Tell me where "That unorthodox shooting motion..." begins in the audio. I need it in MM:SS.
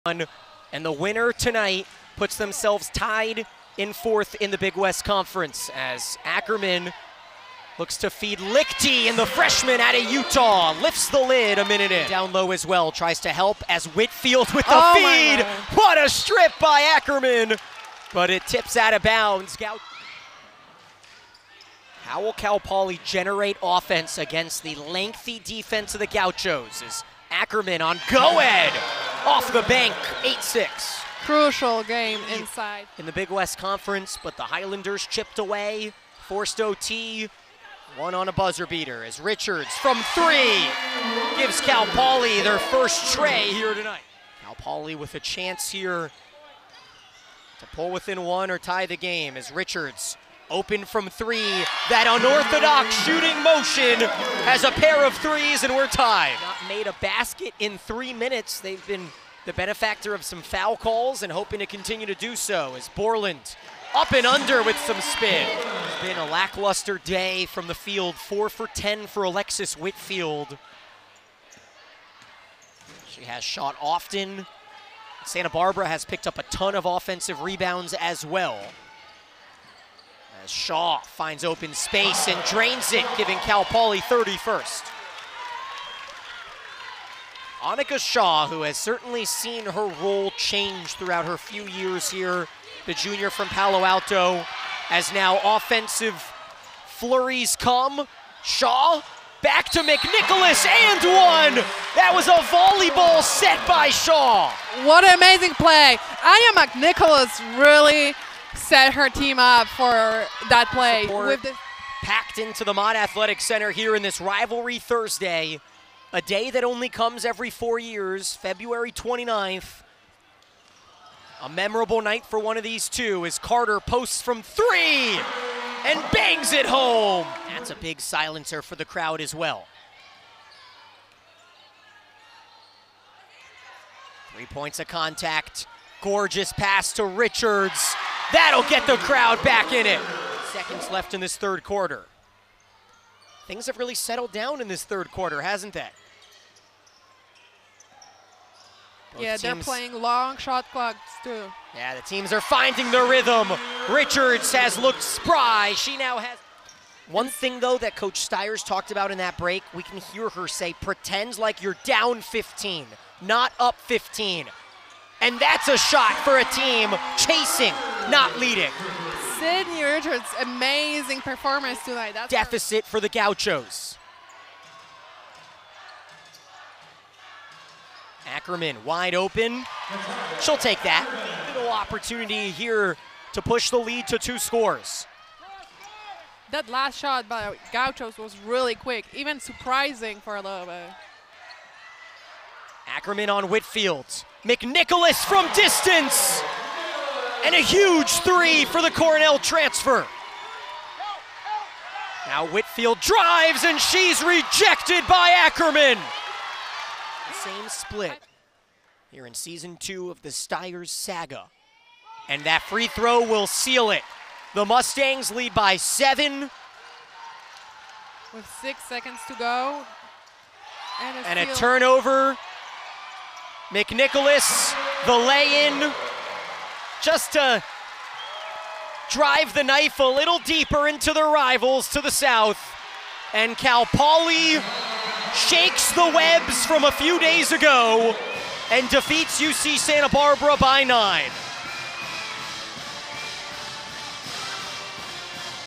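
00:51.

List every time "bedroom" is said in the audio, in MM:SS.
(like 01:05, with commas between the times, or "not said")
not said.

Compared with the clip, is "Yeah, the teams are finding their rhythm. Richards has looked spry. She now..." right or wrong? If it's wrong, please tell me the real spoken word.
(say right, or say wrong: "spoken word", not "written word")
right.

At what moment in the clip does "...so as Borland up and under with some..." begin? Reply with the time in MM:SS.
01:02.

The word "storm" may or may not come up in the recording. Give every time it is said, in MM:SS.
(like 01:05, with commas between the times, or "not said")
not said.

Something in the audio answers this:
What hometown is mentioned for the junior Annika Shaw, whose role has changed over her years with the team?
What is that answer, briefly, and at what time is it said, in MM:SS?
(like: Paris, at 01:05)
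Palo Alto, at 01:33.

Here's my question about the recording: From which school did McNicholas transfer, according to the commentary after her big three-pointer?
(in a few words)
Cornell.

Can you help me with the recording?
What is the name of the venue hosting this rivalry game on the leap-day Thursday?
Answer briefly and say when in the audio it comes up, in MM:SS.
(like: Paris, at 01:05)
Mott Athletic Center, at 01:52.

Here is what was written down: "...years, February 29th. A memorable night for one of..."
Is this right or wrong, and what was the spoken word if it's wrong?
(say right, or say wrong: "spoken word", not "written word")
right.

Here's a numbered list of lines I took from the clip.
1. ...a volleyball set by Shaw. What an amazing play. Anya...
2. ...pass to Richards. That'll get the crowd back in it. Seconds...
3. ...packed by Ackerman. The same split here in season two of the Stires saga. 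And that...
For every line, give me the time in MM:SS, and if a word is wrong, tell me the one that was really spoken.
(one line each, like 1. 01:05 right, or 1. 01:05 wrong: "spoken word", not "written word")
1. 01:42 right
2. 02:16 right
3. 03:24 wrong: "rejected", not "packed".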